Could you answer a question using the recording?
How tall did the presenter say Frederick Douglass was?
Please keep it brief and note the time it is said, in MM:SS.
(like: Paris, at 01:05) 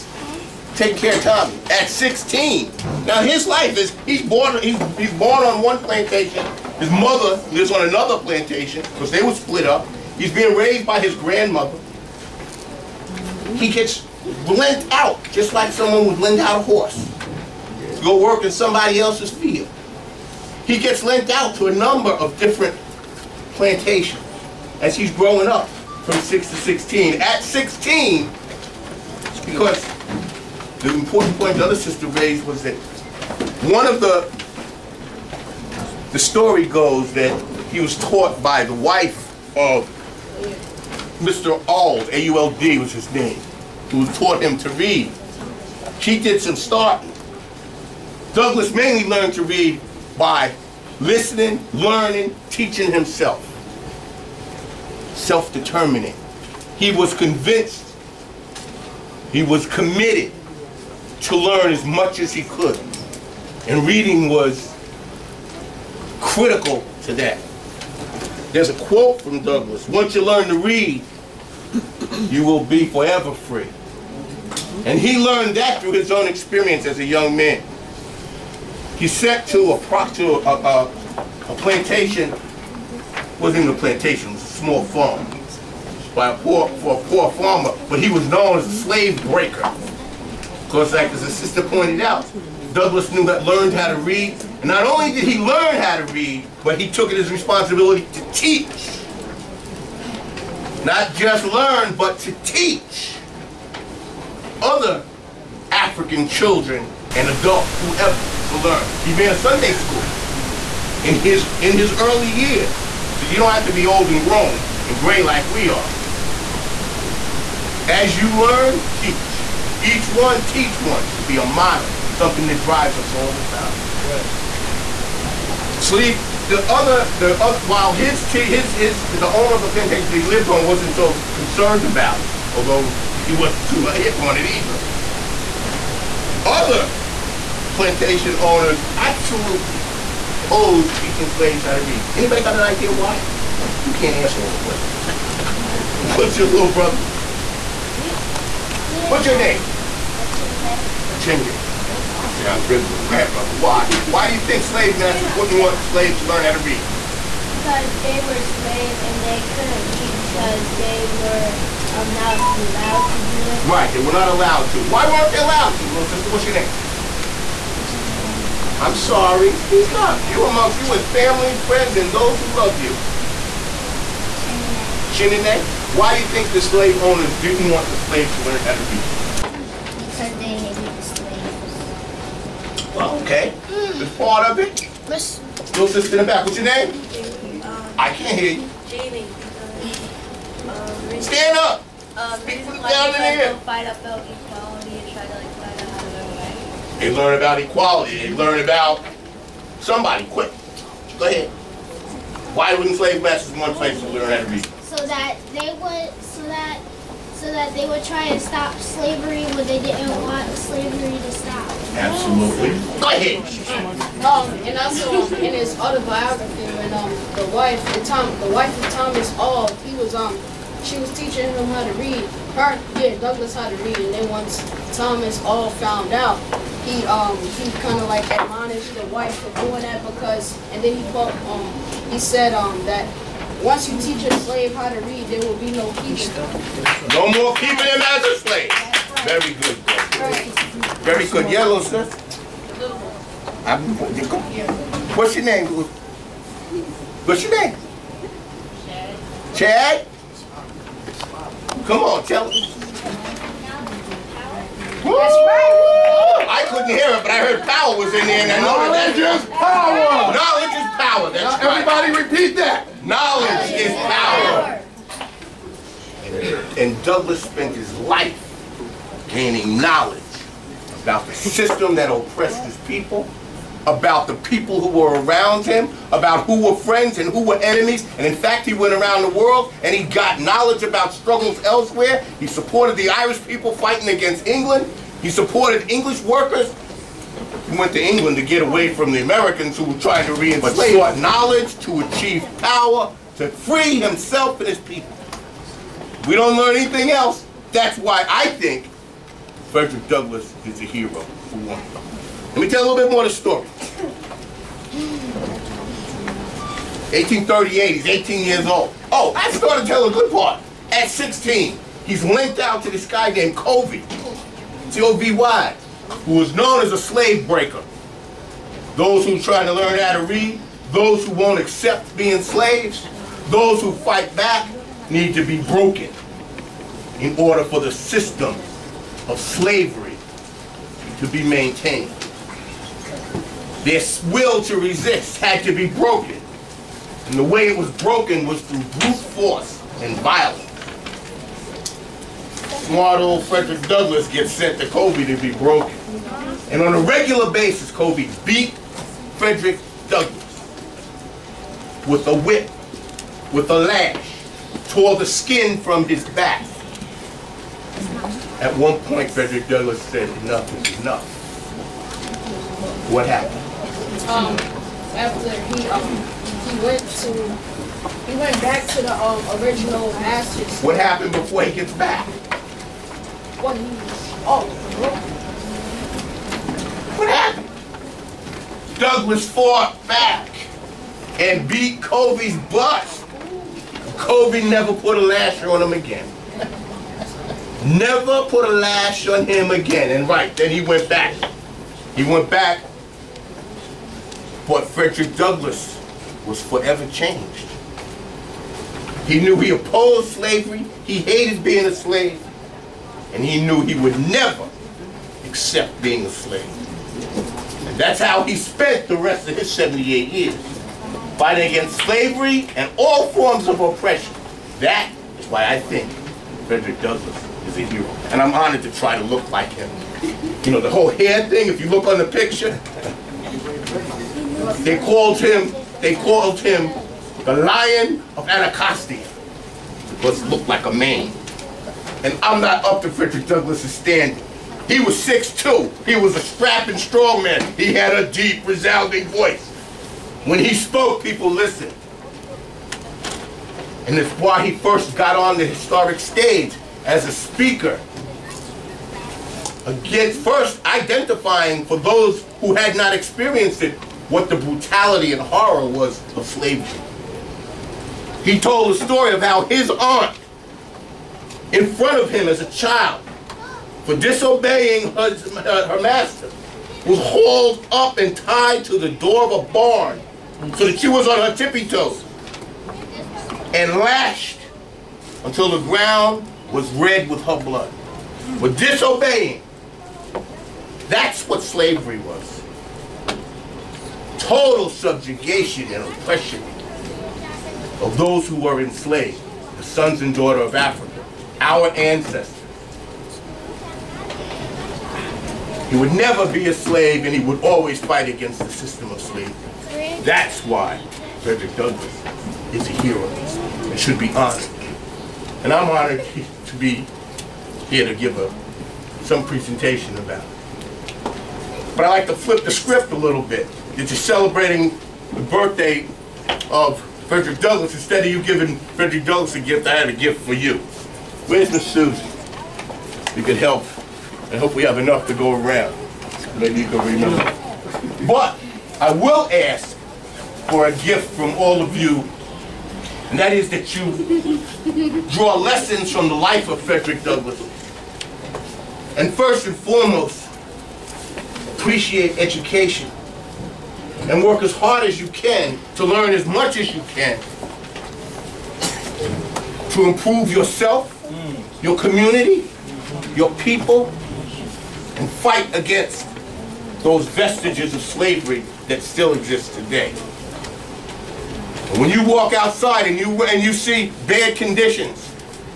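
6'2", at 07:15.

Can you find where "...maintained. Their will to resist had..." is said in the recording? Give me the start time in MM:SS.
05:31.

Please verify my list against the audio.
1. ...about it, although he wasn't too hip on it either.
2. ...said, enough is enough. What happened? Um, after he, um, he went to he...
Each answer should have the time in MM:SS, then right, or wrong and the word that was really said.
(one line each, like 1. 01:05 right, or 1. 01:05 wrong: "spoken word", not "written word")
1. 02:11 right
2. 06:00 right.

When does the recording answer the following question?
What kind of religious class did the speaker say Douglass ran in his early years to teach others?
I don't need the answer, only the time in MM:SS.
01:49.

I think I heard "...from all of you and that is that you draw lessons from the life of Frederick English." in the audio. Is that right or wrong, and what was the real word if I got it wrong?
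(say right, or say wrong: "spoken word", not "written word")
wrong: "Douglass", not "English".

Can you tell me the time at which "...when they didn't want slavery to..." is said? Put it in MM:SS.
03:29.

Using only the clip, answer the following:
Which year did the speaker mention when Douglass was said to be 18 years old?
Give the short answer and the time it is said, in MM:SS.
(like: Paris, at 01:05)
1838, at 05:07.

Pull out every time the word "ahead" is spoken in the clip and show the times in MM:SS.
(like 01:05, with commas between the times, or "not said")
03:21, 03:33.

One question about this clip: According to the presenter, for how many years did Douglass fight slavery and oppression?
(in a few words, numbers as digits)
78.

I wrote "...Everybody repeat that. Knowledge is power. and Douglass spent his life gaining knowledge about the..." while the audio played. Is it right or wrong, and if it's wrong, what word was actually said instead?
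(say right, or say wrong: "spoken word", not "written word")
right.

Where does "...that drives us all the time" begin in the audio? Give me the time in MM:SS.
02:02.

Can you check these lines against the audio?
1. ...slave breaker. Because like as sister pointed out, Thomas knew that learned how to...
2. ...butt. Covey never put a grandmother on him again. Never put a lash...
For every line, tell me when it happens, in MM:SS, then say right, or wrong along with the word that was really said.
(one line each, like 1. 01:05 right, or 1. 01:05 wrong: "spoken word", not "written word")
1. 01:28 wrong: "Douglass", not "Thomas"
2. 06:22 wrong: "lasher", not "grandmother".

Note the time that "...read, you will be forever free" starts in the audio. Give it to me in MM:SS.
01:10.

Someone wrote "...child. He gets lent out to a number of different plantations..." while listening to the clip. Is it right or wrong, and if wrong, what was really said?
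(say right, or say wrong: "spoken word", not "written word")
wrong: "field", not "child".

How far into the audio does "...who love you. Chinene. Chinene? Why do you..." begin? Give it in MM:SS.
02:52.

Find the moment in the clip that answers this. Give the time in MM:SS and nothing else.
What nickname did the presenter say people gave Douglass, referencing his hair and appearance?
07:07.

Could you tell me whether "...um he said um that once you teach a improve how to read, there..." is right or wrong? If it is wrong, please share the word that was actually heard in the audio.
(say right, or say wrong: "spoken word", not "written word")
wrong: "slave", not "improve".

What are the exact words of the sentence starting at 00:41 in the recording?
Auld, A-U-L-D was his name, who taught him to read.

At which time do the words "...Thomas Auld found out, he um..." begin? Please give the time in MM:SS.
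03:44.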